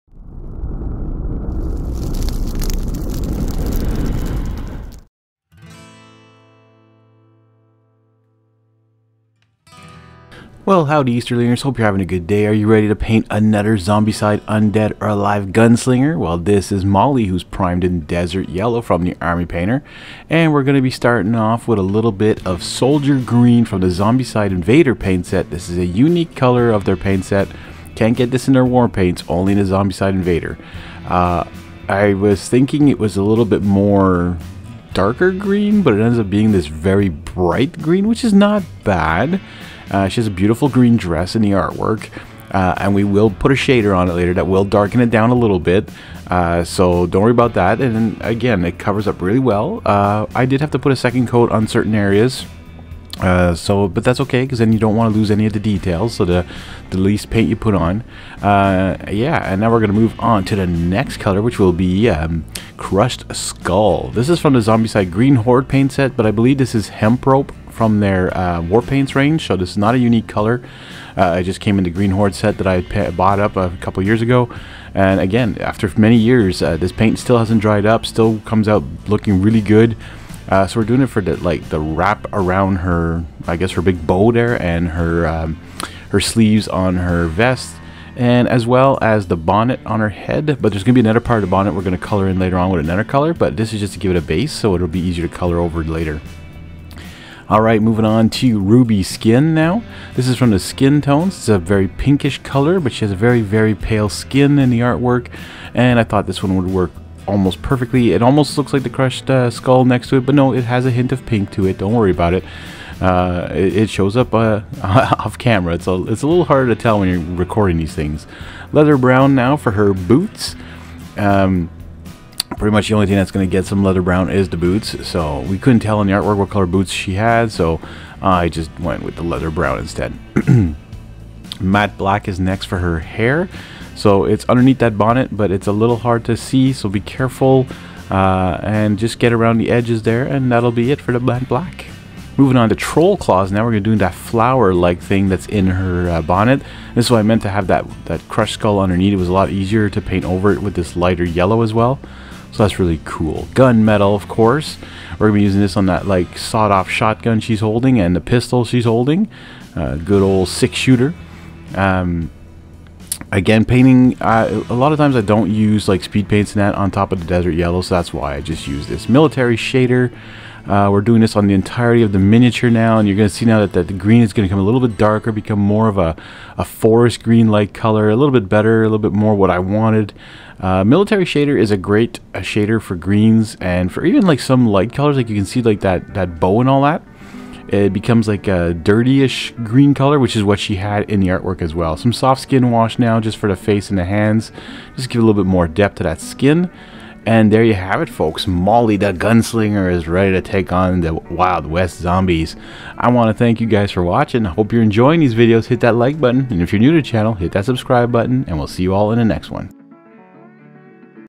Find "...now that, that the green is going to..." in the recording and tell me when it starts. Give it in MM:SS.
02:53.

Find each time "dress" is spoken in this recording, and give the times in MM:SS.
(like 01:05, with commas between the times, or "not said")
00:40.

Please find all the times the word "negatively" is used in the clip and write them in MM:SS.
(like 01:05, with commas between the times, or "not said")
not said.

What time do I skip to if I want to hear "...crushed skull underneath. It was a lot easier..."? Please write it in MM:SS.
02:28.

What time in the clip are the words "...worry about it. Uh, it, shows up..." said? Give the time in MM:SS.
01:51.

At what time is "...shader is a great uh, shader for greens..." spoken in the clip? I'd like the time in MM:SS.
03:01.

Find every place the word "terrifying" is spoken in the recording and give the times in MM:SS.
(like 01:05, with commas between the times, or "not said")
not said.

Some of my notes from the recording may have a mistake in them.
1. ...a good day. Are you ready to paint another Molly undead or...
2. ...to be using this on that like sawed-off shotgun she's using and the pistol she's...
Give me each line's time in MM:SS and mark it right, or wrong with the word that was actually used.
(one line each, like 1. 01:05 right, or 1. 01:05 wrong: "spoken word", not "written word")
1. 00:11 wrong: "Zombicide", not "Molly"
2. 02:35 wrong: "holding", not "using".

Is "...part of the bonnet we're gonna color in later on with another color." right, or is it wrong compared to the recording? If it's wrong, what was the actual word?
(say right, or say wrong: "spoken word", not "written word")
right.